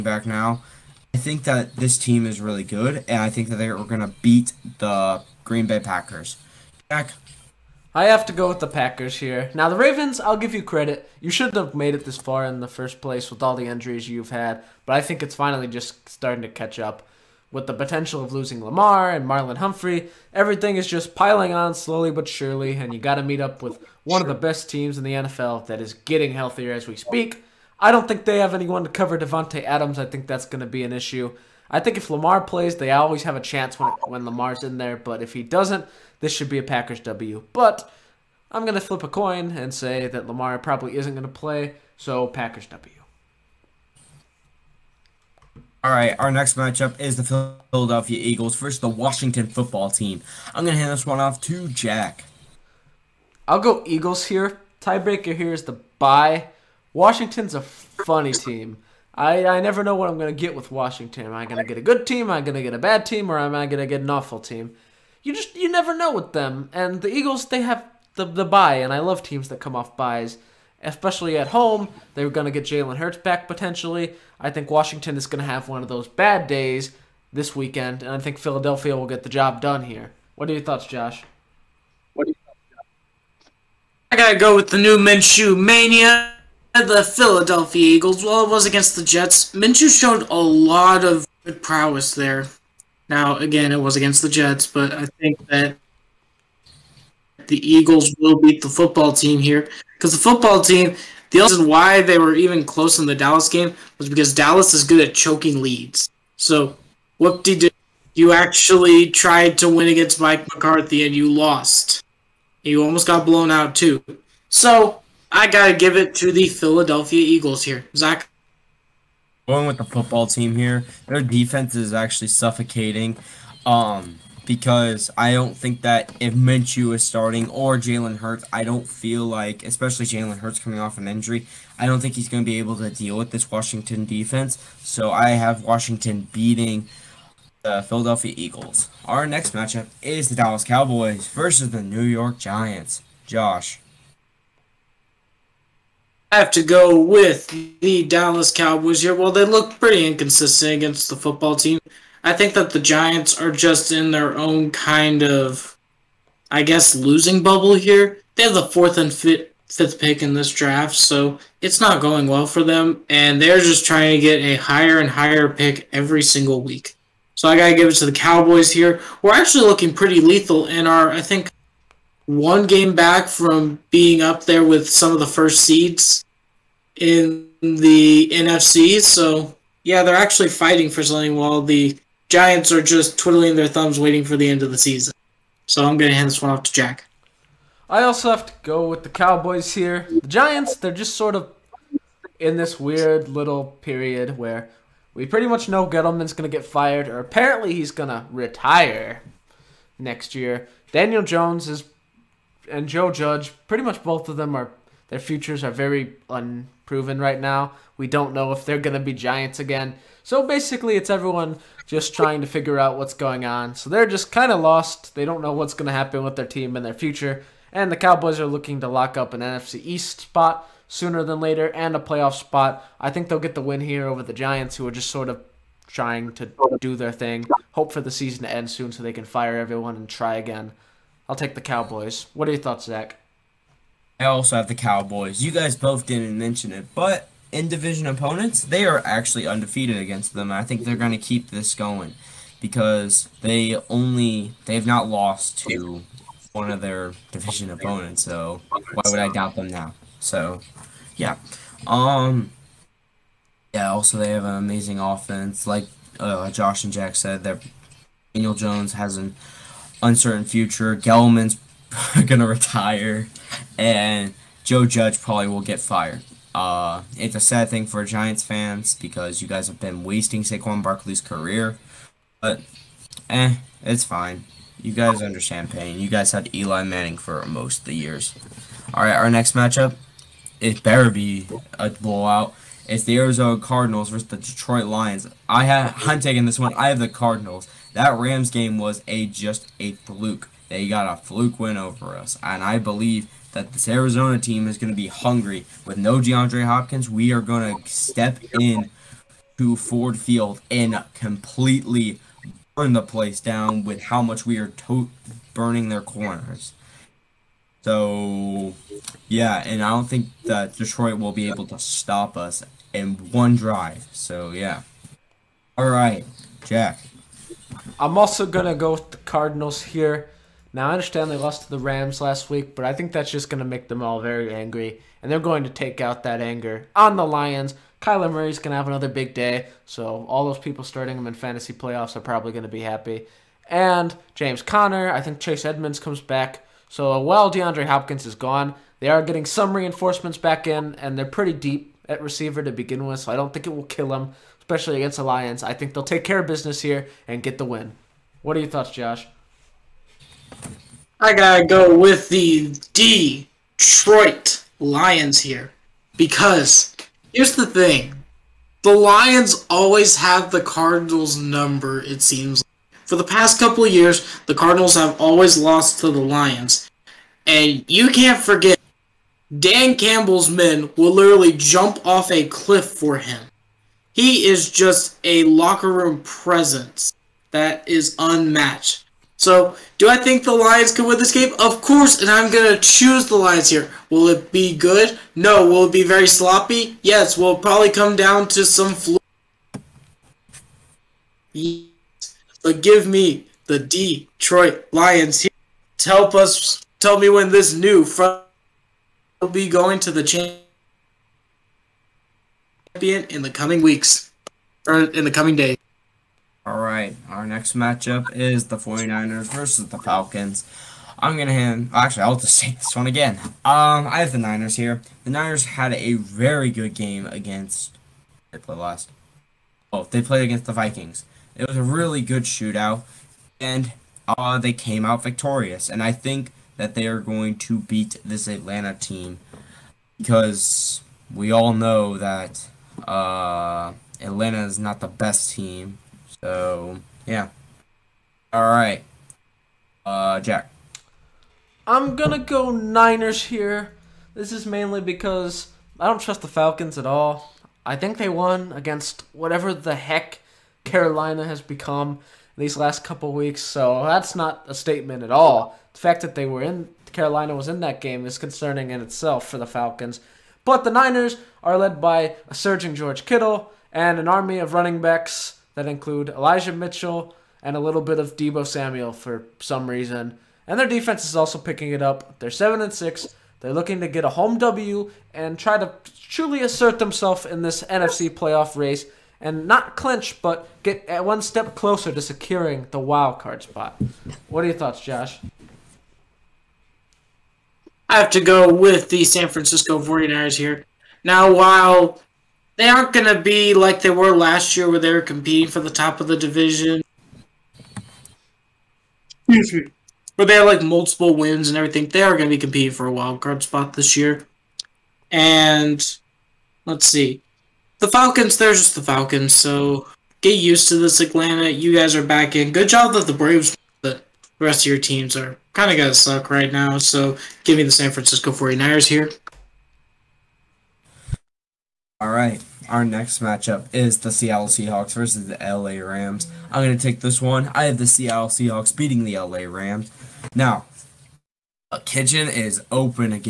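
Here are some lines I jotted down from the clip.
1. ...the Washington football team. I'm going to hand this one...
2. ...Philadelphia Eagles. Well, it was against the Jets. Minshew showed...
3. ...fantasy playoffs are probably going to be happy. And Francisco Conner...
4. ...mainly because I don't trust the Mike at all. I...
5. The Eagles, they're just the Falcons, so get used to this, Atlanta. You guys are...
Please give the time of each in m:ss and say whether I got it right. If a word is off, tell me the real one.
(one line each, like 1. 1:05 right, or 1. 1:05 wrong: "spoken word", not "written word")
1. 0:48 right
2. 1:27 right
3. 5:31 wrong: "James", not "Francisco"
4. 7:24 wrong: "Falcons", not "Mike"
5. 8:28 wrong: "Falcons", not "Eagles".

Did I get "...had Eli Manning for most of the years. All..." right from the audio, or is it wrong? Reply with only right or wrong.
right.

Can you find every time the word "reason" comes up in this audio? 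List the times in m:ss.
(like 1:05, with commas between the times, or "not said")
1:41, 7:49.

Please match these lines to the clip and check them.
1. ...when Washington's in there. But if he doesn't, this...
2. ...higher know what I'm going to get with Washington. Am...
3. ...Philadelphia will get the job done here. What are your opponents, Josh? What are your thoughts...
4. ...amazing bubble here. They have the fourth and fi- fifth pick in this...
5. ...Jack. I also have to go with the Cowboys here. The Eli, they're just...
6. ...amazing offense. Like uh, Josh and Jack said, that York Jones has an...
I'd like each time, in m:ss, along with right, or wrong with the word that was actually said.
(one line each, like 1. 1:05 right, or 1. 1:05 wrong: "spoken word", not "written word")
1. 0:34 wrong: "Lamar", not "Washington"
2. 0:59 wrong: "never", not "higher"
3. 1:18 wrong: "thoughts", not "opponents"
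4. 2:36 wrong: "losing", not "amazing"
5. 3:06 wrong: "Giants", not "Eli"
6. 4:14 wrong: "Daniel", not "York".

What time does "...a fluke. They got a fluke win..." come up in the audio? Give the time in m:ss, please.
4:49.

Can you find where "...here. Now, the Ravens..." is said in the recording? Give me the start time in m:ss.
0:09.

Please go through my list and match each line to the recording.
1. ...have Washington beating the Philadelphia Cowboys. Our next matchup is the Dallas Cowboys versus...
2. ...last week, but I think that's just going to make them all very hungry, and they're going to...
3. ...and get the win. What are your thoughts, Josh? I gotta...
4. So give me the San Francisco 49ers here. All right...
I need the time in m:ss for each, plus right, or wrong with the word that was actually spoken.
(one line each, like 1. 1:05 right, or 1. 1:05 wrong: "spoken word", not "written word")
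1. 2:15 wrong: "Eagles", not "Cowboys"
2. 5:22 wrong: "angry", not "hungry"
3. 5:47 right
4. 8:36 right.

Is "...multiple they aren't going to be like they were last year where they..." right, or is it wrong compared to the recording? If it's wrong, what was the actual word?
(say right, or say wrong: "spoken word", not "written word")
wrong: "while", not "multiple".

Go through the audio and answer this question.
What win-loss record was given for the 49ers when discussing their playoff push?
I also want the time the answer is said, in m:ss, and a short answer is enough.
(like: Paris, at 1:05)
7 and 6, at 7:52.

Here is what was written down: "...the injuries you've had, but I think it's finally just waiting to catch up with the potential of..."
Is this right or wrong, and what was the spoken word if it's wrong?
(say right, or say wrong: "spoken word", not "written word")
wrong: "starting", not "waiting".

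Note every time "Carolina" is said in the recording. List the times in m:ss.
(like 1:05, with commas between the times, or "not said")
7:30, 7:37.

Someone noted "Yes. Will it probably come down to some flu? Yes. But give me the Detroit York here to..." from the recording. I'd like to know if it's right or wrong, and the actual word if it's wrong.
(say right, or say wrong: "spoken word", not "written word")
wrong: "Lions", not "York".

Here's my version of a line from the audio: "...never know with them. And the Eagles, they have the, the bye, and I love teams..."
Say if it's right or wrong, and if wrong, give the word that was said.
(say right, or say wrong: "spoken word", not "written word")
right.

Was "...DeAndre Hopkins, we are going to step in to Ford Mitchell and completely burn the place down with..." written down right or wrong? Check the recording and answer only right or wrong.
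wrong.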